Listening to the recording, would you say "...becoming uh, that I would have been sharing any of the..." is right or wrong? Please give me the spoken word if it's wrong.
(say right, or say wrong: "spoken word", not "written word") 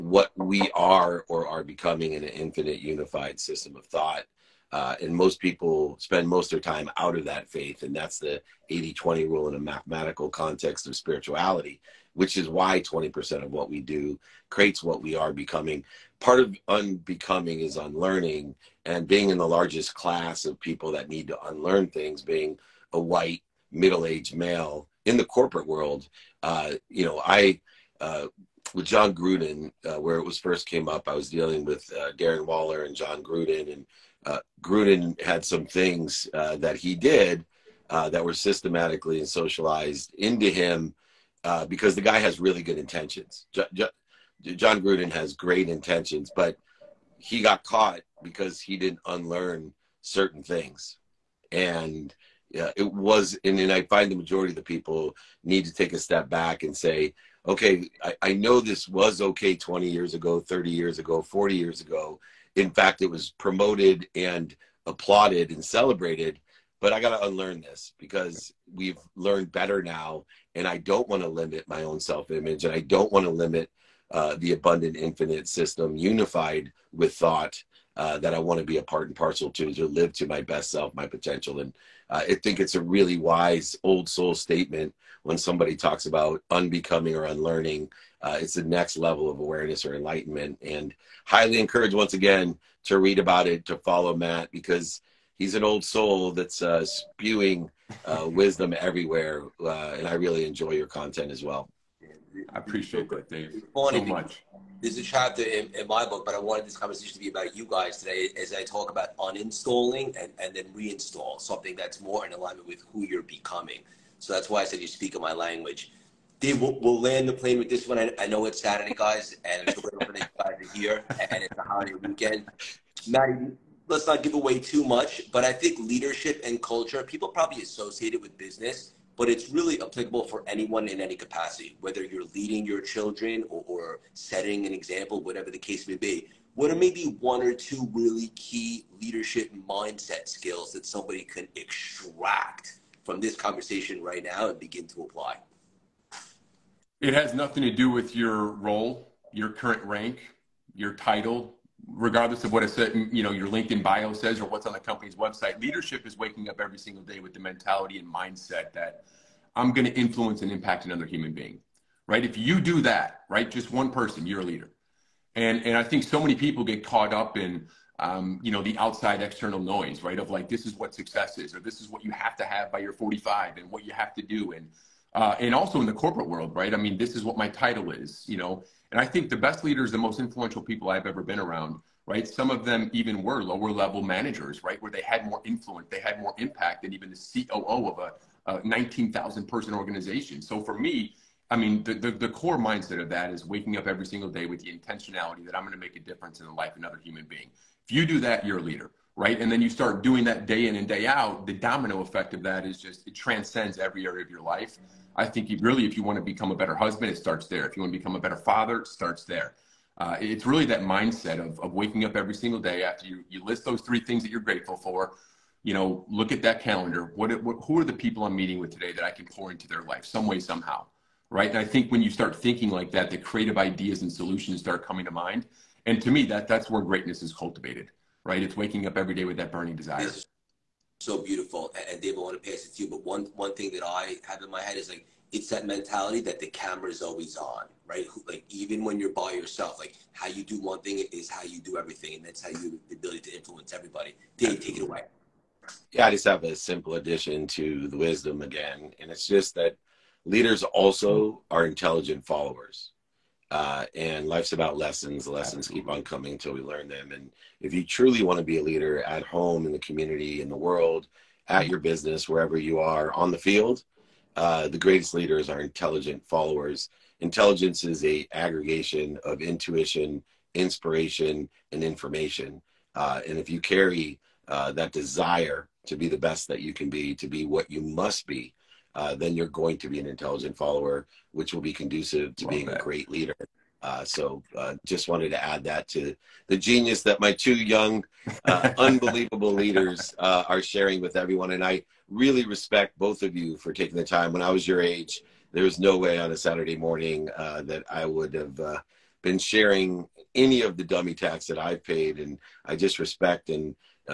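wrong: "morning", not "becoming".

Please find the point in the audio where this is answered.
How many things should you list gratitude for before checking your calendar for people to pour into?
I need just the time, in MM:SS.
03:33.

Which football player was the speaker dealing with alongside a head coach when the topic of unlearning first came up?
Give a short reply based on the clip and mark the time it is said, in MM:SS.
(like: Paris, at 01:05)
Darren Waller, at 00:32.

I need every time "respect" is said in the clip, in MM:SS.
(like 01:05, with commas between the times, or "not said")
04:52, 05:02.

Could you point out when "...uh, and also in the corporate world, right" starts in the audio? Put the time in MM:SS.
02:55.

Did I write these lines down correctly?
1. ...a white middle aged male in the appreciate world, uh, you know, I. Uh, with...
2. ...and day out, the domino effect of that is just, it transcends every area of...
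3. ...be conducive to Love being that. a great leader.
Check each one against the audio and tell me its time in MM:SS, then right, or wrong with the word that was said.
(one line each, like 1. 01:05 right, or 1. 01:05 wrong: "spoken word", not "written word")
1. 00:22 wrong: "corporate", not "appreciate"
2. 03:20 right
3. 04:41 right.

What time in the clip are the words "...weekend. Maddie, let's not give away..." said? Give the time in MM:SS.
02:01.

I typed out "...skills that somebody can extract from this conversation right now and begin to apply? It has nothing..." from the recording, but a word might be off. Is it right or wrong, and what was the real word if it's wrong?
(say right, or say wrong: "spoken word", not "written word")
right.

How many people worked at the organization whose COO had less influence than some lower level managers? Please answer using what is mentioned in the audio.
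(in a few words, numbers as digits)
19000.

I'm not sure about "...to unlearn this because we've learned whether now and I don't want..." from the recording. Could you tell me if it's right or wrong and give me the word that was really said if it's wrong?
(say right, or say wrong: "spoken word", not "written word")
wrong: "better", not "whether".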